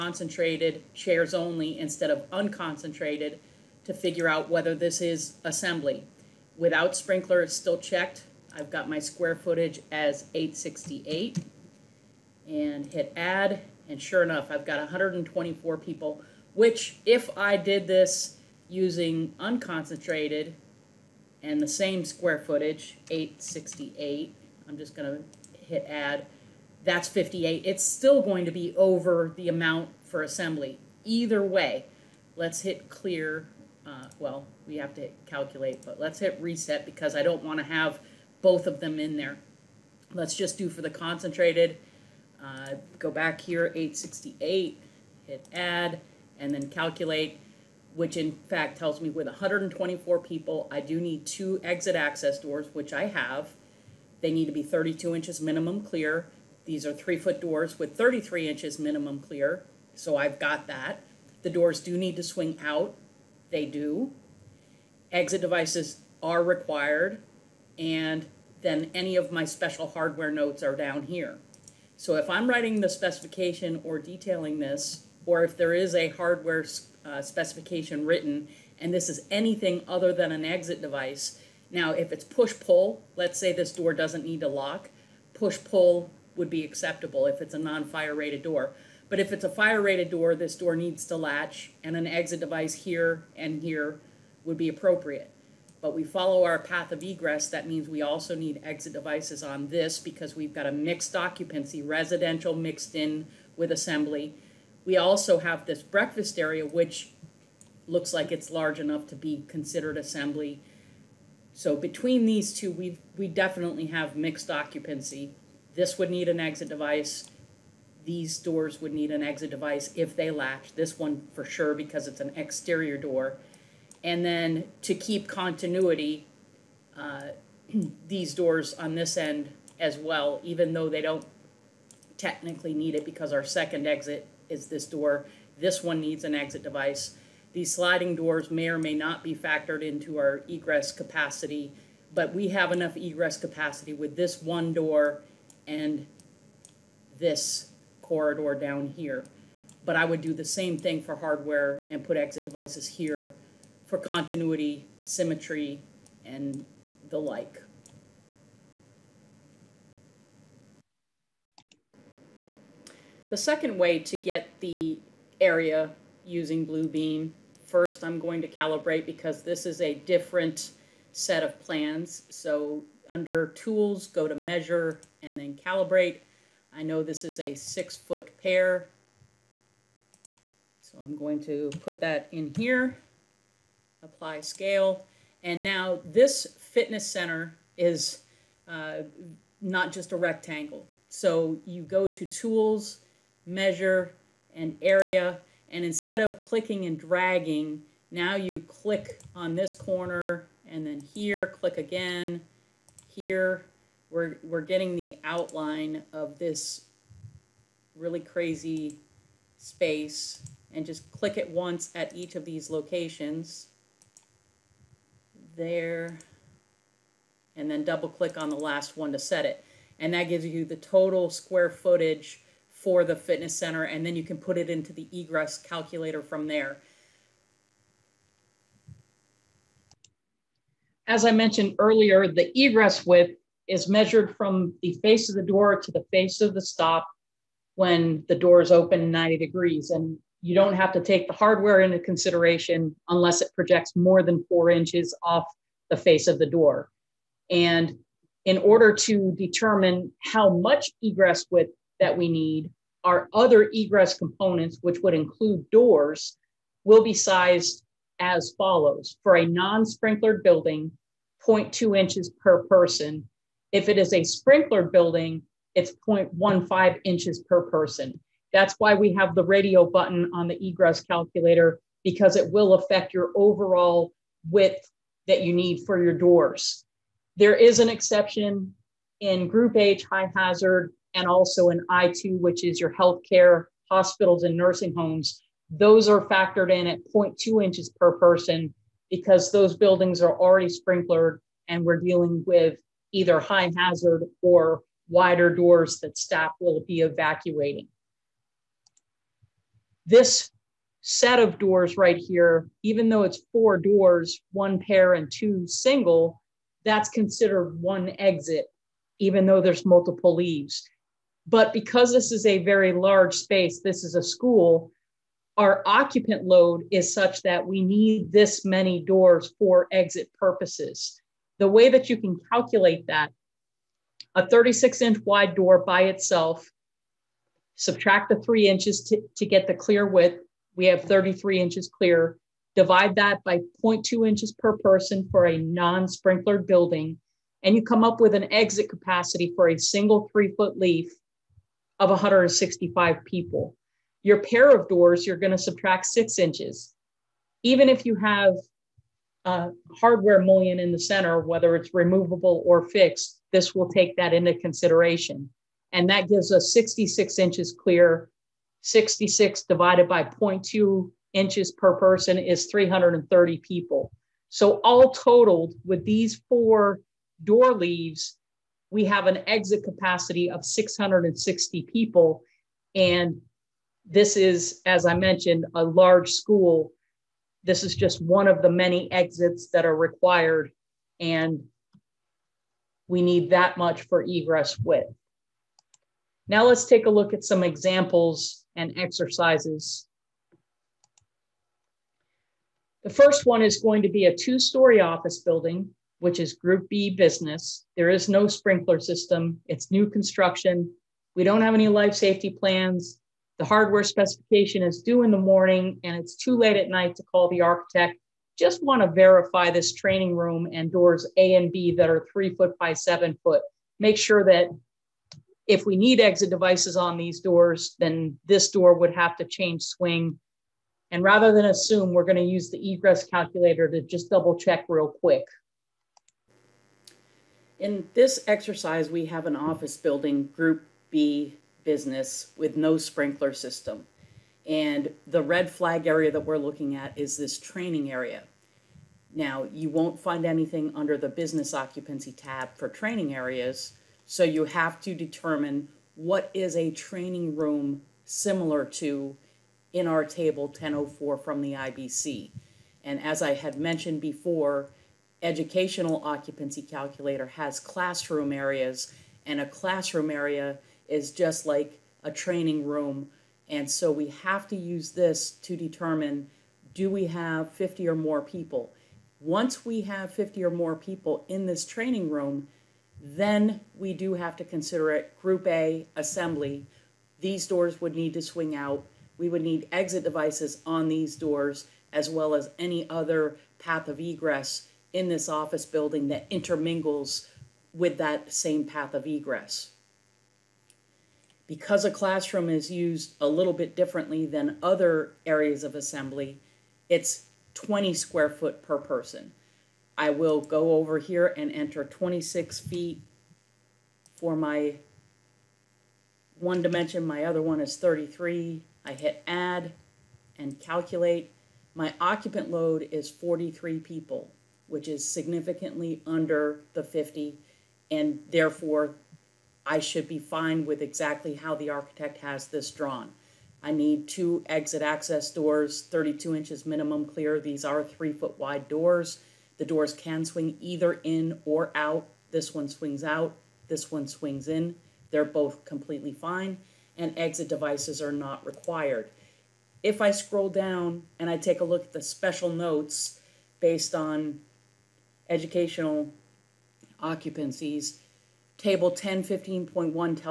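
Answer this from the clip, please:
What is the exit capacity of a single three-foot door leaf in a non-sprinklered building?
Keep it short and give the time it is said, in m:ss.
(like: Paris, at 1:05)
165 people, at 5:42.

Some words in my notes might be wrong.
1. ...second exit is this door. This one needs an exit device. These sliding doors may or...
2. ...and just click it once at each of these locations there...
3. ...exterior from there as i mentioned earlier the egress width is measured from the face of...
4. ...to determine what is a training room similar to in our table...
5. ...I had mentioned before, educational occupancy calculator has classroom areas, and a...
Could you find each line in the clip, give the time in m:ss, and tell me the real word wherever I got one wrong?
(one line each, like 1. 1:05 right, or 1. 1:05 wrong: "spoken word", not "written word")
1. 2:13 right
2. 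3:30 right
3. 3:45 wrong: "calculator", not "exterior"
4. 7:25 right
5. 7:33 right.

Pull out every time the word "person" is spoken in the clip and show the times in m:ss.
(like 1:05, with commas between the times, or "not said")
4:22, 4:27, 4:48, 5:34, 6:01, 8:18.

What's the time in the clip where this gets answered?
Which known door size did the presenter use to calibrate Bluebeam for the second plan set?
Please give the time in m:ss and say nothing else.
2:57.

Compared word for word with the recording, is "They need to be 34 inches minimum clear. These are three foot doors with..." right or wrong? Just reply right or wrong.
wrong.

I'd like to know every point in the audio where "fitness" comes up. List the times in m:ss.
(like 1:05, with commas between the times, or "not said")
3:06, 3:43.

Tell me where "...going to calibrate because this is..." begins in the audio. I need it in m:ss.
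2:48.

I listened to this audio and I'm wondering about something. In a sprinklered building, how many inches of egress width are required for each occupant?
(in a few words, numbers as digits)
0.15 inches.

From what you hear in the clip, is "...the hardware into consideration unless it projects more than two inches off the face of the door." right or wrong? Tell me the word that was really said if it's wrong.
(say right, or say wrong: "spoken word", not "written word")
wrong: "four", not "two".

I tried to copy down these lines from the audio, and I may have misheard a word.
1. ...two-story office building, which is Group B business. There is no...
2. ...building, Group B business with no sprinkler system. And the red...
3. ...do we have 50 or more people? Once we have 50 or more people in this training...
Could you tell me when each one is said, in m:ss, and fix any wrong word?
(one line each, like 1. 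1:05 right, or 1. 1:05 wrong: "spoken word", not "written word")
1. 6:34 right
2. 7:09 right
3. 7:46 right.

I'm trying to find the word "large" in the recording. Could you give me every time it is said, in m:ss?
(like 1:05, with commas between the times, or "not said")
1:48, 5:12, 6:15.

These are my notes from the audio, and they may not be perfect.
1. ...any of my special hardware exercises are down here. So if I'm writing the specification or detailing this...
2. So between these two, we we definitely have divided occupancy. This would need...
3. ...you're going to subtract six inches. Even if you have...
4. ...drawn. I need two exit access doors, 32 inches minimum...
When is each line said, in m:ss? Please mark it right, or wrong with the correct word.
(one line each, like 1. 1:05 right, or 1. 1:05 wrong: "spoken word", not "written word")
1. 1:08 wrong: "notes", not "exercises"
2. 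1:51 wrong: "mixed", not "divided"
3. 5:45 right
4. 8:42 right.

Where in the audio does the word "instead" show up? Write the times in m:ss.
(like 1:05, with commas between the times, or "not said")
0:01, 3:15.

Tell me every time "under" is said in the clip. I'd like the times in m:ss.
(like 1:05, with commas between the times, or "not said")
2:53, 7:20, 8:36.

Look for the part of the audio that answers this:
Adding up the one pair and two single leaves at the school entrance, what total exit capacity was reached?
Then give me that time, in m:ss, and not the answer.
6:10.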